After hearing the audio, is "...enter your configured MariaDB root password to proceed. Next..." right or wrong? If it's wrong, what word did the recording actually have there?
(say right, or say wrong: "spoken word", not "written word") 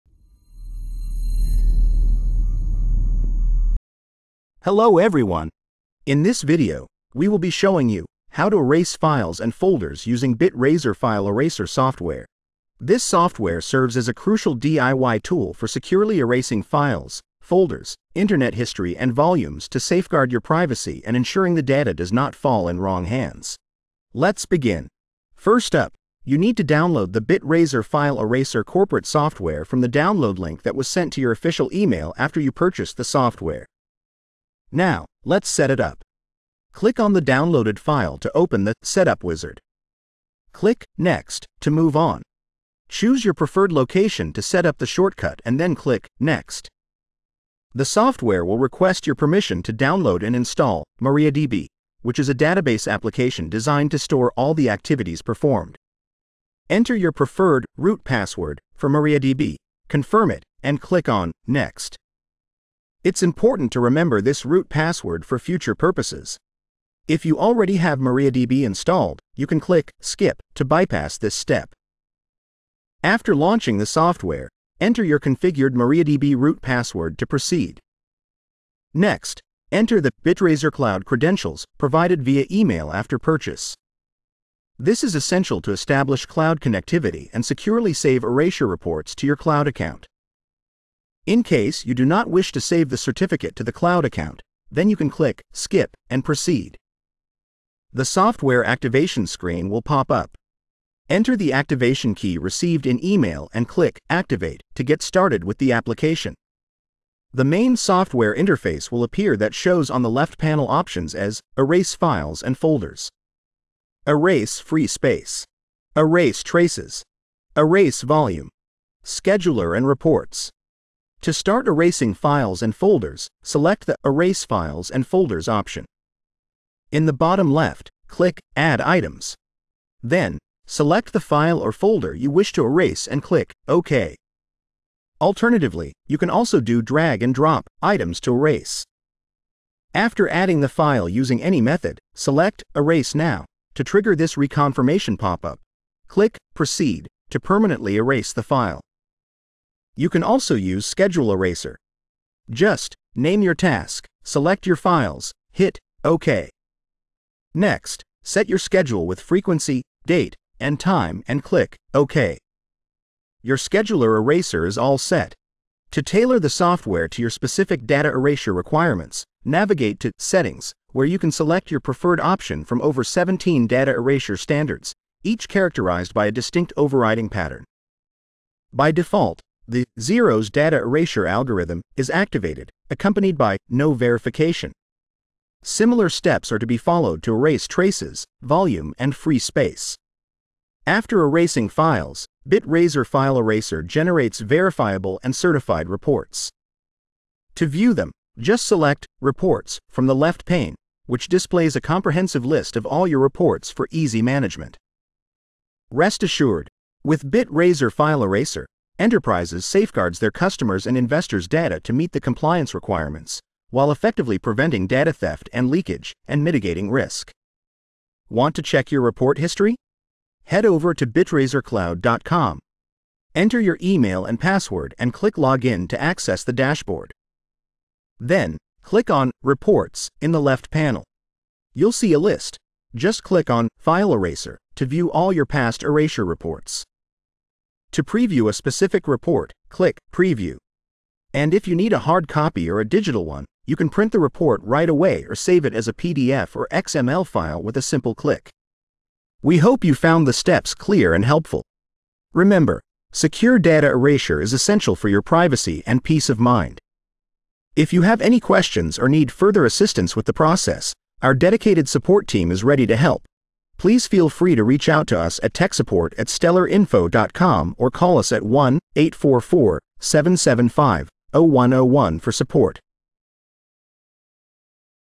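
right.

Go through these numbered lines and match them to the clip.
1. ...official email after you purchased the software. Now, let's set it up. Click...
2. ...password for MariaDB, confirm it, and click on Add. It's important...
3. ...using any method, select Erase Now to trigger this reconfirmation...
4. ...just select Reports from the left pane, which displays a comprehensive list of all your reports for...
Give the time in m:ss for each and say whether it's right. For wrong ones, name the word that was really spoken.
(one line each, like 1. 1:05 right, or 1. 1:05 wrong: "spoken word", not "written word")
1. 0:31 right
2. 0:58 wrong: "Next", not "Add"
3. 2:21 right
4. 3:18 right.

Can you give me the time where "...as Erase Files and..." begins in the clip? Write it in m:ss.
1:51.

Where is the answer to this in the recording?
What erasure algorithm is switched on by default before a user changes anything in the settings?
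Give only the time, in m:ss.
2:59.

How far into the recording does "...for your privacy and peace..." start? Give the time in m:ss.
4:14.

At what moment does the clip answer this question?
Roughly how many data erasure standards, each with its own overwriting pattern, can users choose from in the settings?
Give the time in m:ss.
2:52.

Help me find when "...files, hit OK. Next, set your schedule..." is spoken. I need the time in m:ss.
2:34.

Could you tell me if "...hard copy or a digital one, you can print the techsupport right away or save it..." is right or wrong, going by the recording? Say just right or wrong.
wrong.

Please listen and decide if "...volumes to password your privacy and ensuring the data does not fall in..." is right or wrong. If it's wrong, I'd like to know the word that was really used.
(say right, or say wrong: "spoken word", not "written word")
wrong: "safeguard", not "password".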